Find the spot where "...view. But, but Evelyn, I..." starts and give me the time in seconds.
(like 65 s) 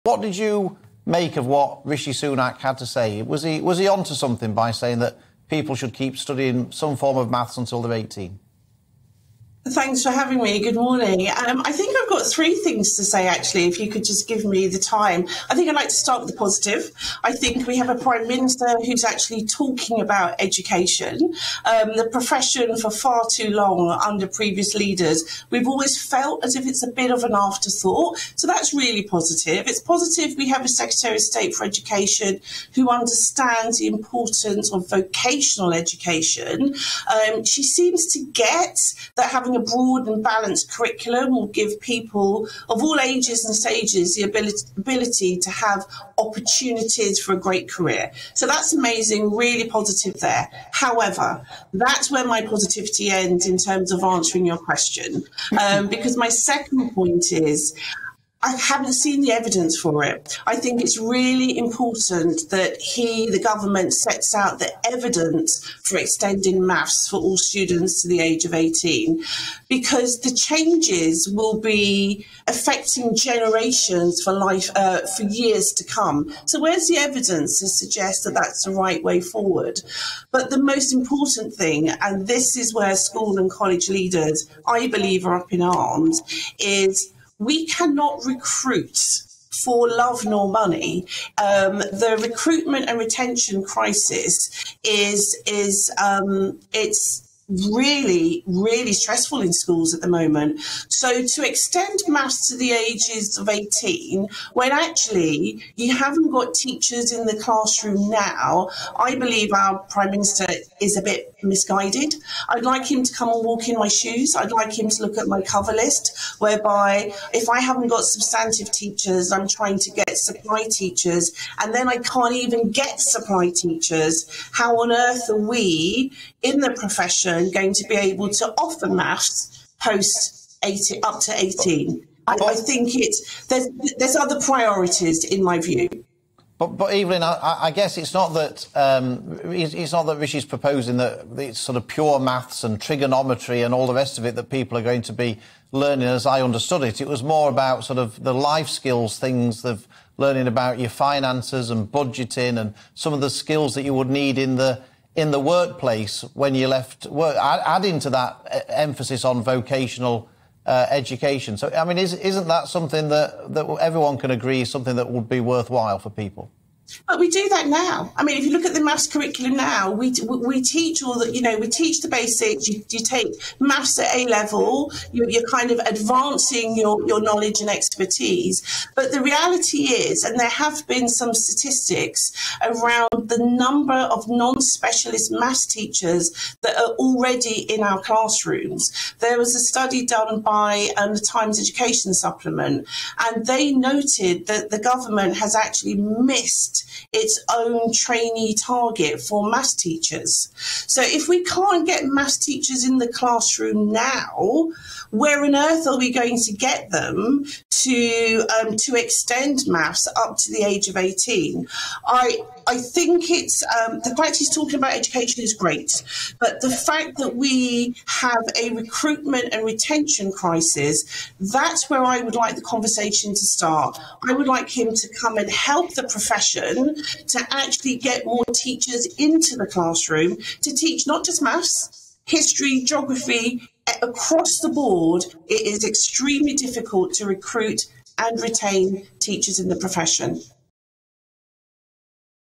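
135 s.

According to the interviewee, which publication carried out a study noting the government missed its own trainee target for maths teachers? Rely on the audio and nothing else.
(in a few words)
Times Education Supplement.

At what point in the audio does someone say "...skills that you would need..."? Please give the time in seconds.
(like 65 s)
153 s.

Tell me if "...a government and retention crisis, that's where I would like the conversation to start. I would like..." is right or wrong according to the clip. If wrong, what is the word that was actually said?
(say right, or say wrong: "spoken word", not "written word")
wrong: "recruitment", not "government".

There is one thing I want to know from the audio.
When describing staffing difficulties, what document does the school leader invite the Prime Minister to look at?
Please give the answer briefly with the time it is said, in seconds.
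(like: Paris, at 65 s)
cover list, at 115 s.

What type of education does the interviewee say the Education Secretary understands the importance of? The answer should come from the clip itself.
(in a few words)
vocational education.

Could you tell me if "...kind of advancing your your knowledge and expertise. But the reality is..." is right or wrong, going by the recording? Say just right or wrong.
right.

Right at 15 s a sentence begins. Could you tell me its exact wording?
I think I'd like to start with the positive.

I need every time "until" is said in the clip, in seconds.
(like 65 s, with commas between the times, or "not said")
7 s.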